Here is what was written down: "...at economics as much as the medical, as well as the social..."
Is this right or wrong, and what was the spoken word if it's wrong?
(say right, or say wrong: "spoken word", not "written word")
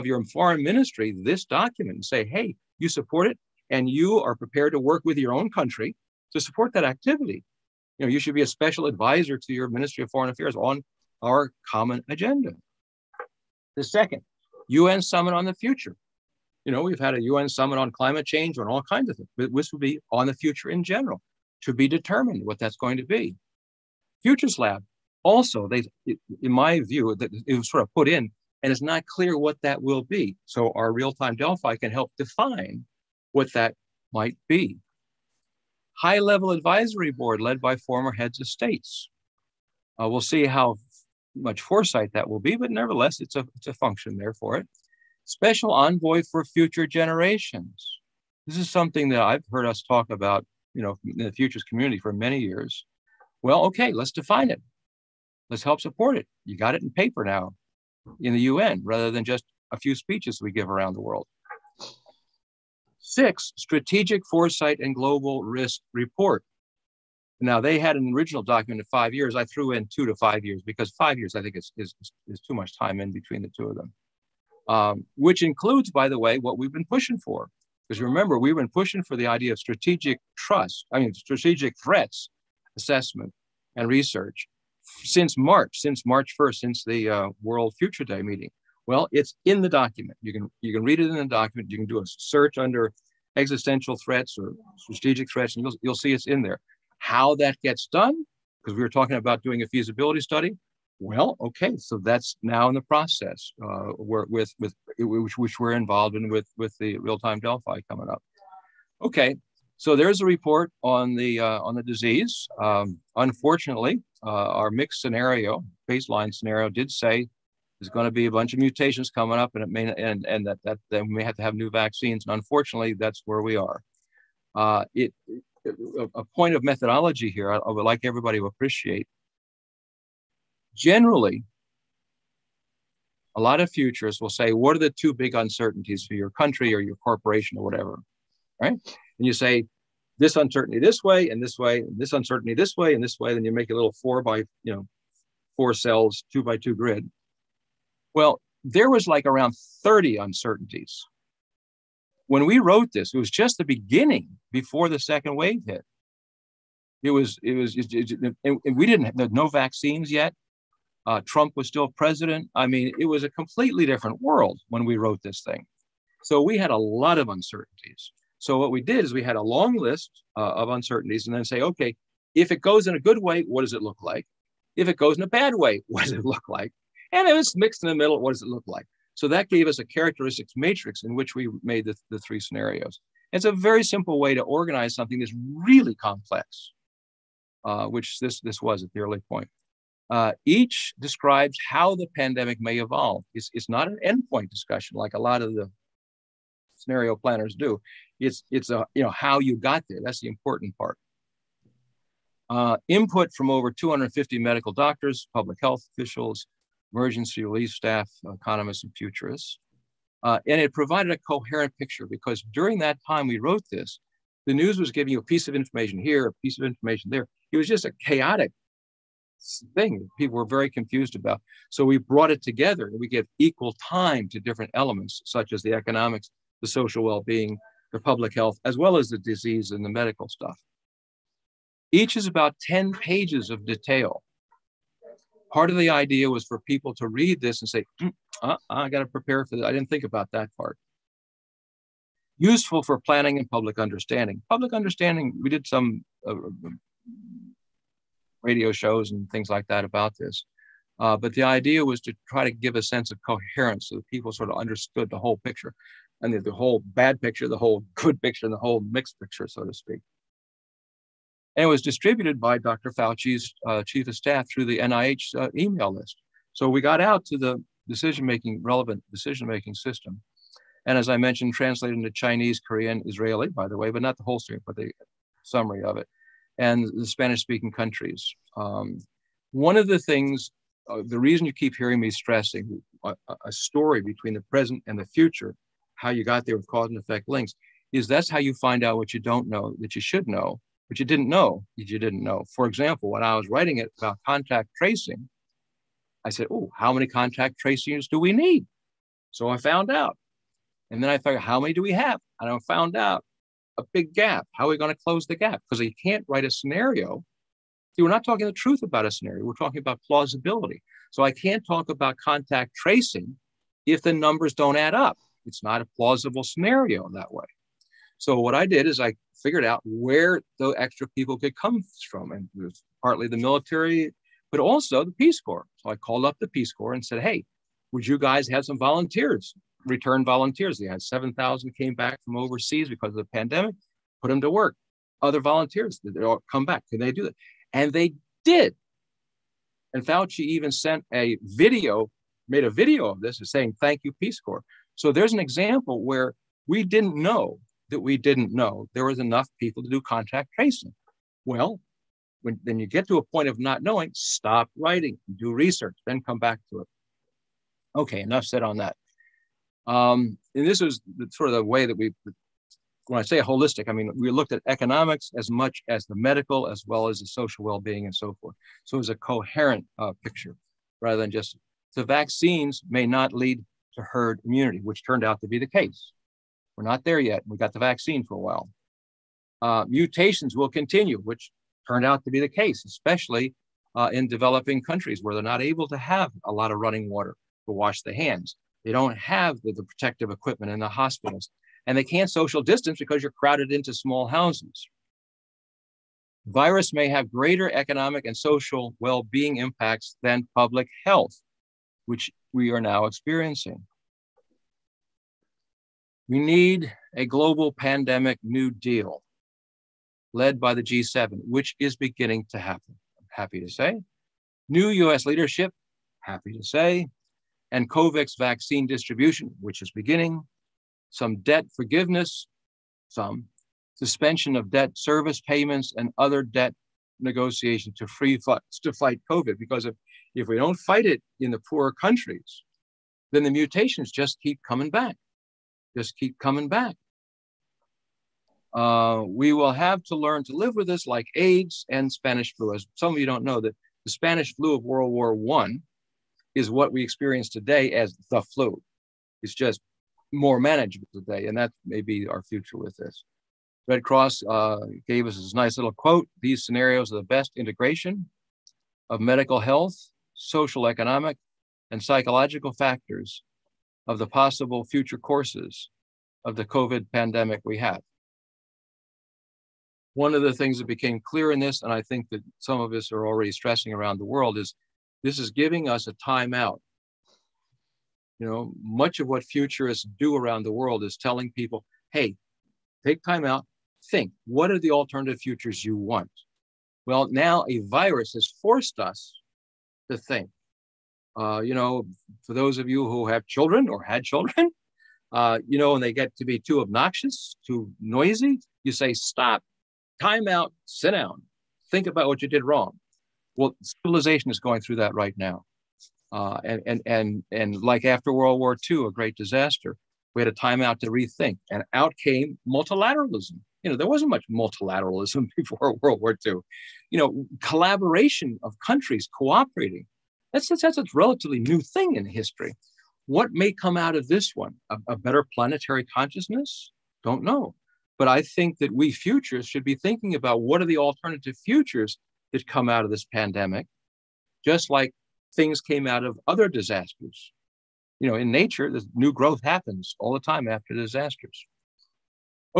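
right.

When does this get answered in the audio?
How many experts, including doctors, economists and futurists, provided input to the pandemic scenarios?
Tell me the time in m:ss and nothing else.
3:23.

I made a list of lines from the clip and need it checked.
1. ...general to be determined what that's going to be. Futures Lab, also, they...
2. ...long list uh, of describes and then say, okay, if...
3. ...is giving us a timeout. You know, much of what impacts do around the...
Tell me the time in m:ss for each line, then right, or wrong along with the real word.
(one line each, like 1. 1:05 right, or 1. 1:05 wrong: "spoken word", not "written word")
1. 0:20 right
2. 2:49 wrong: "uncertainties", not "describes"
3. 7:55 wrong: "futurists", not "impacts".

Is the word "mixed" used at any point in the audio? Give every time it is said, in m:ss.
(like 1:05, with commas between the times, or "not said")
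1:54, 2:57, 4:18.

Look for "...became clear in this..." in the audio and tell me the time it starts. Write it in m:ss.
7:50.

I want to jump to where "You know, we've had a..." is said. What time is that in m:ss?
0:16.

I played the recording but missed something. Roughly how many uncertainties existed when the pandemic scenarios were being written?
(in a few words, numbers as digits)
30.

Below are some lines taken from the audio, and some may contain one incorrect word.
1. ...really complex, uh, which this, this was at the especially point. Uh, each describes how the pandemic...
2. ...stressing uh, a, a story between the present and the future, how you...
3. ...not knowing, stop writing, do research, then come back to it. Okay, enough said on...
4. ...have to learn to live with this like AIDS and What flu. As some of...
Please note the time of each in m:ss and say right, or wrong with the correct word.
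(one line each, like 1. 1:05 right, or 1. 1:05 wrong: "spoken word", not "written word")
1. 3:05 wrong: "early", not "especially"
2. 4:42 right
3. 5:53 right
4. 7:19 wrong: "Spanish", not "What".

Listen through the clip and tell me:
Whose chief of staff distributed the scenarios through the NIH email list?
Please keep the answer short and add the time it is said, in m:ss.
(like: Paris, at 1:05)
Dr. Fauci, at 4:22.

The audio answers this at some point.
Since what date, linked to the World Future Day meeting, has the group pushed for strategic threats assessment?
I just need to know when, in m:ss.
1:26.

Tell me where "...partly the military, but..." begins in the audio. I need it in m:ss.
5:23.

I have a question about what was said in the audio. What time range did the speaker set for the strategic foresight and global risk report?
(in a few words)
2 to 5 years.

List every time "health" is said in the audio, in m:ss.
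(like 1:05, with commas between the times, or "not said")
3:25, 3:48, 6:41, 7:39.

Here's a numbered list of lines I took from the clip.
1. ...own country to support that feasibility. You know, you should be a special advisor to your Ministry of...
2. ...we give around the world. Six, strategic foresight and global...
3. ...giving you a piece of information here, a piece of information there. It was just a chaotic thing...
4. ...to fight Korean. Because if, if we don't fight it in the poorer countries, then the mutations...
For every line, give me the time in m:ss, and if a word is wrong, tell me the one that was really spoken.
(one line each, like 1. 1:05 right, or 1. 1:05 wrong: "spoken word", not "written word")
1. 0:05 wrong: "activity", not "feasibility"
2. 1:00 right
3. 3:34 right
4. 7:08 wrong: "COVID", not "Korean".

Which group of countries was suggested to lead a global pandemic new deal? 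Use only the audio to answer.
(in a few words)
G7.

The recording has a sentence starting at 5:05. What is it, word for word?
Because you can't write a scenario.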